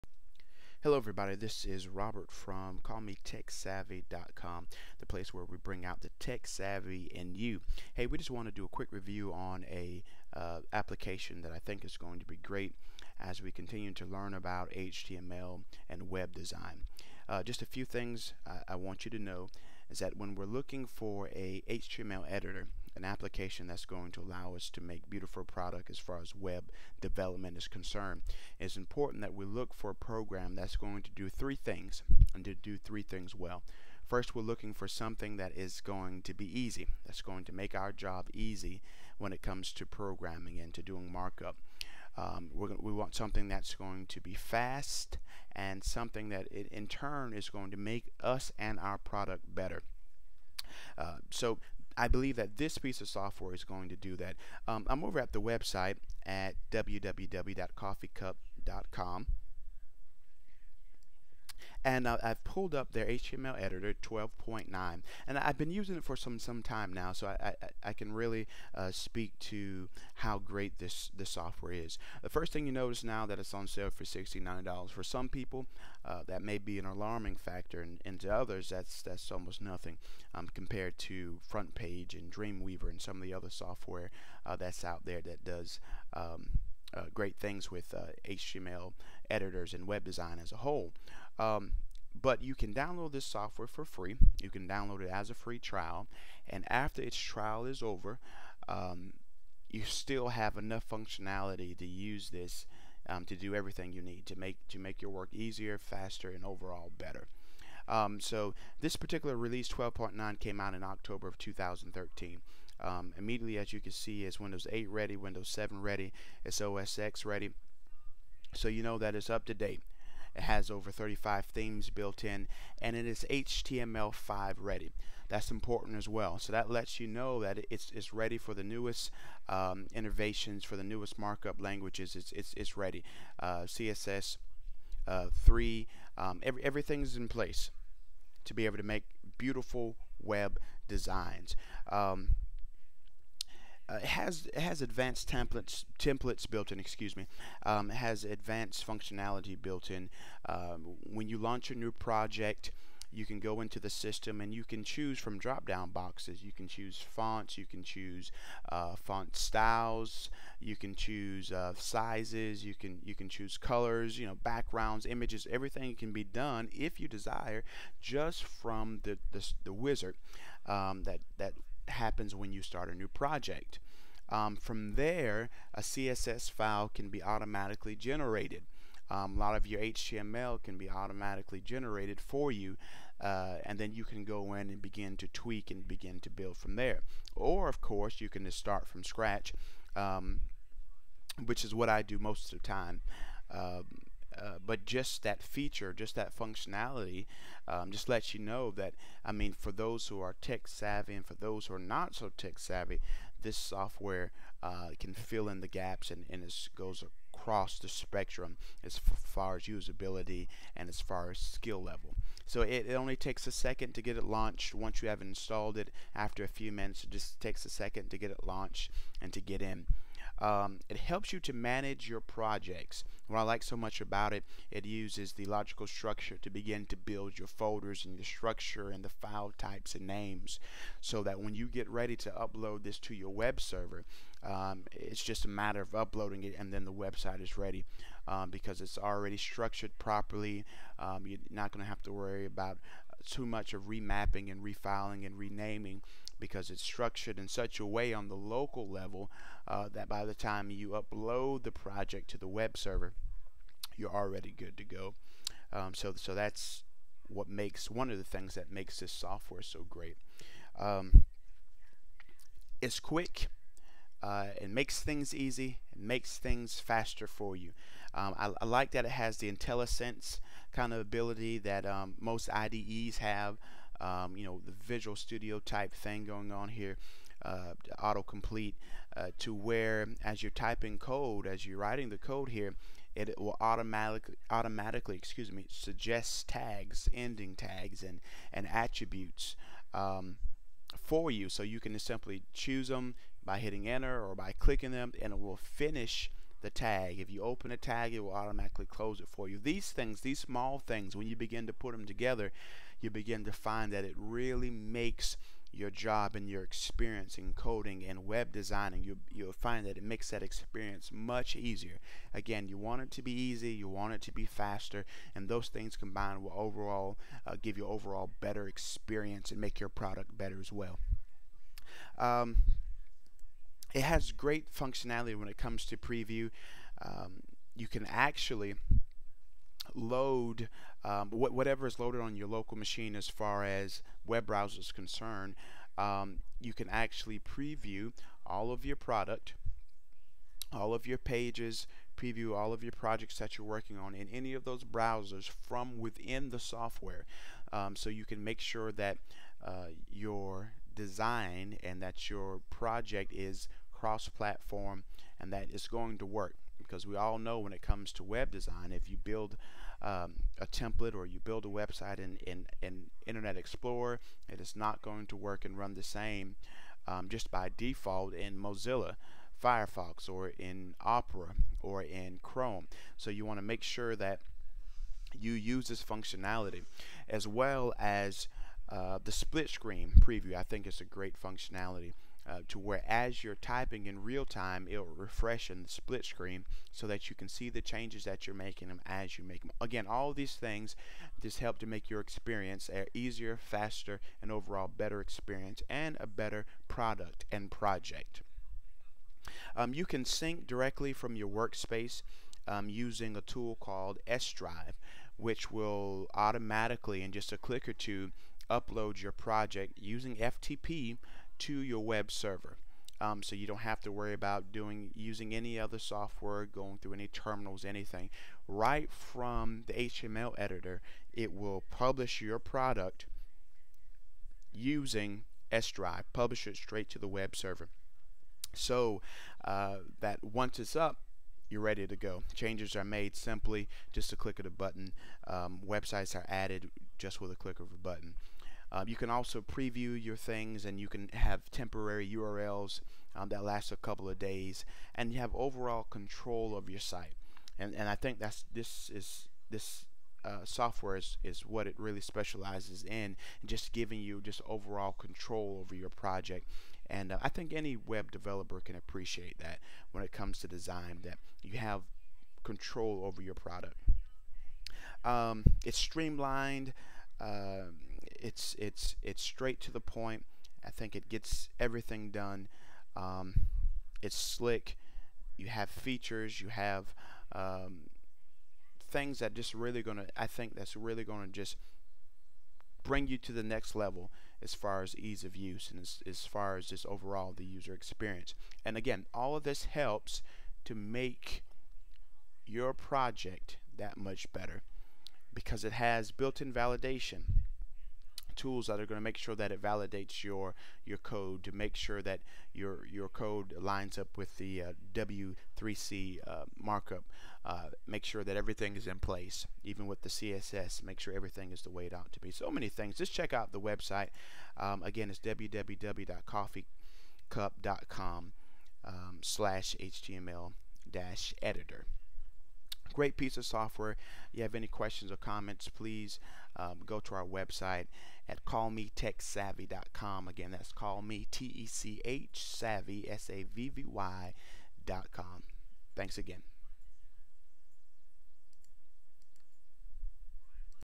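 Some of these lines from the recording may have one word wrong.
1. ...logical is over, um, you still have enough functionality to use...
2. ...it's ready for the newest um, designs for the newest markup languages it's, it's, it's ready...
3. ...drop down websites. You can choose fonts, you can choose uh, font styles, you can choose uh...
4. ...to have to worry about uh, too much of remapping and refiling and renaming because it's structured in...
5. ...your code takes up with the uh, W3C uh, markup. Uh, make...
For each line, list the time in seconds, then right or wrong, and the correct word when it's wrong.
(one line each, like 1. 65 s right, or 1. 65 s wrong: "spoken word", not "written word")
1. 97 s wrong: "trial", not "logical"
2. 127 s wrong: "innovations", not "designs"
3. 155 s wrong: "boxes", not "websites"
4. 241 s right
5. 503 s wrong: "lines", not "takes".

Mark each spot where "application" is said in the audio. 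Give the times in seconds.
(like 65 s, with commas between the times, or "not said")
10 s, 23 s.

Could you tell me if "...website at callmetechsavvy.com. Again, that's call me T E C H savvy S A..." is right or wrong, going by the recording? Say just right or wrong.
right.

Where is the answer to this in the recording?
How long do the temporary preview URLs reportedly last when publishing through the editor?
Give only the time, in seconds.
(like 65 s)
443 s.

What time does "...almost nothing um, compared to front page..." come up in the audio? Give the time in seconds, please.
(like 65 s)
79 s.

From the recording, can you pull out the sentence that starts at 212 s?
So it, it, only takes a second to get it launched once you have installed it.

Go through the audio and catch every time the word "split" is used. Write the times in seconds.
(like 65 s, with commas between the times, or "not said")
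379 s, 385 s.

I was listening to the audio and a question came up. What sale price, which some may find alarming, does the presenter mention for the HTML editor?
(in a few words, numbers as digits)
$69.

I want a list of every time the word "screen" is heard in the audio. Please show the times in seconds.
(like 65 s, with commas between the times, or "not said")
379 s, 386 s.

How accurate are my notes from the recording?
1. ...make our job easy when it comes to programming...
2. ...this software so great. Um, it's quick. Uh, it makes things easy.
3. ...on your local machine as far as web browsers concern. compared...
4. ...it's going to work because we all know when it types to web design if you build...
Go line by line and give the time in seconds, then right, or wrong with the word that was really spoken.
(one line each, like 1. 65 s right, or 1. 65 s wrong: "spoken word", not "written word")
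1. 37 s right
2. 258 s right
3. 332 s wrong: "concerned", not "compared"
4. 355 s wrong: "comes", not "types".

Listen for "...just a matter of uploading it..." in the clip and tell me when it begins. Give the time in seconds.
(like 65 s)
235 s.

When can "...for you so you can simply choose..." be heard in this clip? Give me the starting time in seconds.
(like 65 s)
290 s.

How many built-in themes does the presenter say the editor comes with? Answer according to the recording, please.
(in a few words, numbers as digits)
35.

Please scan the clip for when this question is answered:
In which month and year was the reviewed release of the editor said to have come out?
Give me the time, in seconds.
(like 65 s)
110 s.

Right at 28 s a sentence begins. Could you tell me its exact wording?
It's important that we look for a program that's going to do three things and to do three things well.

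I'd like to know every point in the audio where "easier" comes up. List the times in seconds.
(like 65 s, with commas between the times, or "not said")
105 s, 311 s, 393 s.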